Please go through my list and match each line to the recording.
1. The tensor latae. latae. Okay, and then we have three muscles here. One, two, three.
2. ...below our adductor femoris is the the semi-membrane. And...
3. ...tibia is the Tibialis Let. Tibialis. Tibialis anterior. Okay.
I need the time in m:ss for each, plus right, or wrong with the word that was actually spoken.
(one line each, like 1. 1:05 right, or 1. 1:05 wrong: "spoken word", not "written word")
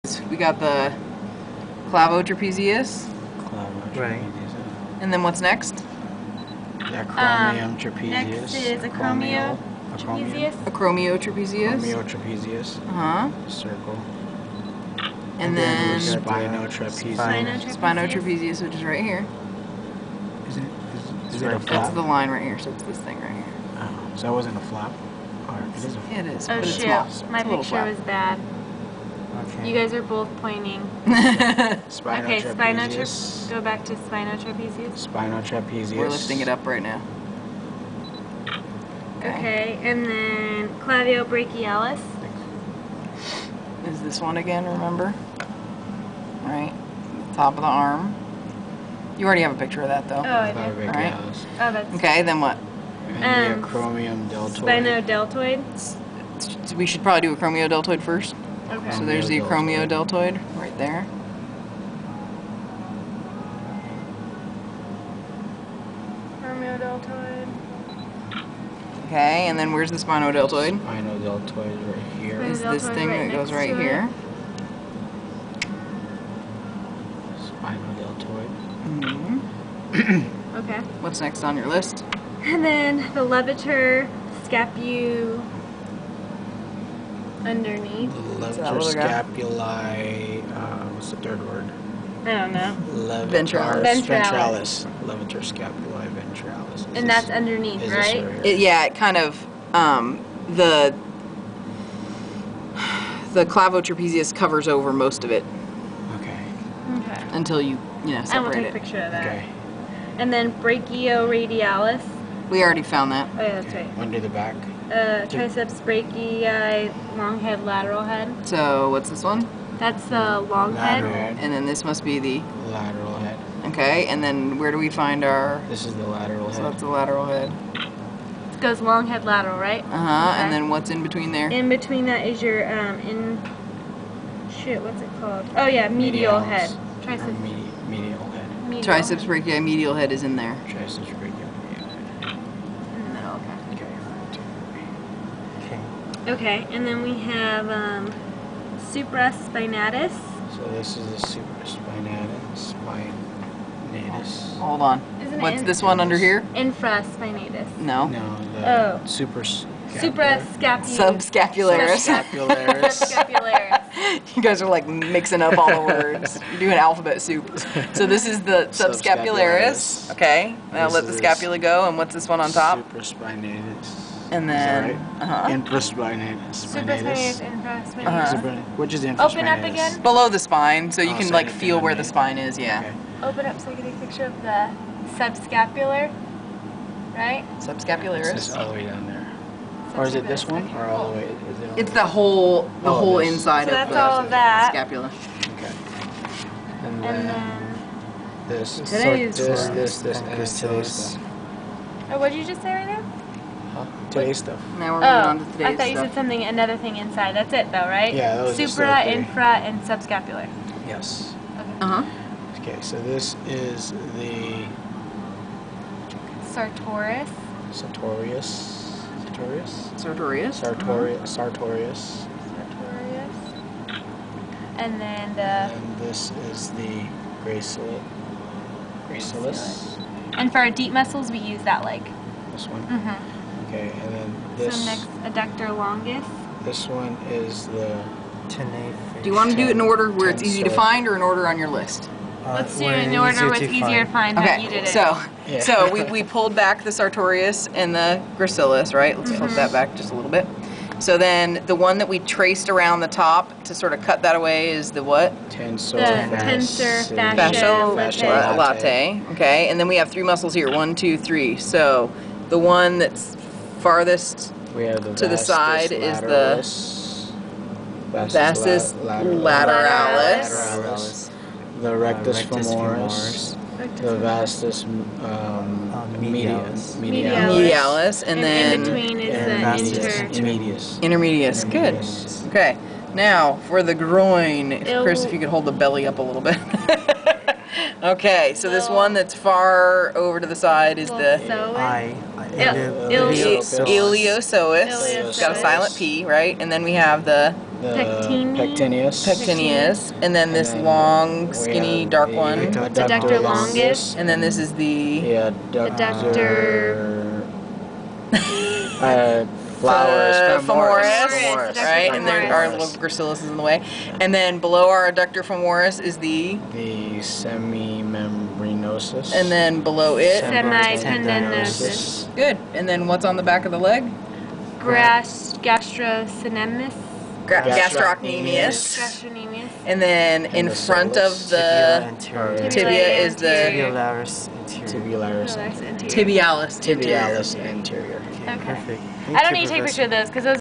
1. 4:15 right
2. 5:14 right
3. 5:32 wrong: "Tibularis", not "Let".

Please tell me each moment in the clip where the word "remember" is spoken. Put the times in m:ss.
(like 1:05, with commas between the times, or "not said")
0:44.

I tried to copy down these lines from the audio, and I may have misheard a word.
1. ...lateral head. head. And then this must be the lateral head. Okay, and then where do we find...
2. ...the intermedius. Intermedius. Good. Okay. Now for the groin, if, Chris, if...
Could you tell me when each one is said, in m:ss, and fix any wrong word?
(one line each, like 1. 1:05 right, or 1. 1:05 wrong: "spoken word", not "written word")
1. 2:00 right
2. 4:39 right.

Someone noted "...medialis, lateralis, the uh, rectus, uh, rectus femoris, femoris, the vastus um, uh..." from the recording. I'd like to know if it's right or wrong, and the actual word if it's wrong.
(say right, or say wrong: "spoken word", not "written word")
wrong: "lateralis", not "medialis".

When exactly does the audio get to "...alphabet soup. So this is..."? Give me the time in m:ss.
2:46.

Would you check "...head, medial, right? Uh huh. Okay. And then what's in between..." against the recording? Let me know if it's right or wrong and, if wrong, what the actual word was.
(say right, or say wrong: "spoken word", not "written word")
wrong: "lateral", not "medial".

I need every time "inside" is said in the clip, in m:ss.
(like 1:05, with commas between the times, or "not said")
3:13, 3:26.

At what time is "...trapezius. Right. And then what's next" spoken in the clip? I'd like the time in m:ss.
0:02.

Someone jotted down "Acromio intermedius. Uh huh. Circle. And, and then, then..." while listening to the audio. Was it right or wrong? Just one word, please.
wrong.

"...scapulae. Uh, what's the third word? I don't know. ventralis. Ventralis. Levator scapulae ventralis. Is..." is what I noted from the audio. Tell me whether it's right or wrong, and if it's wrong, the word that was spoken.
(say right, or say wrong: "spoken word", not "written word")
right.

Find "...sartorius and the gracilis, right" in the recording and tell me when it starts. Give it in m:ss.
4:06.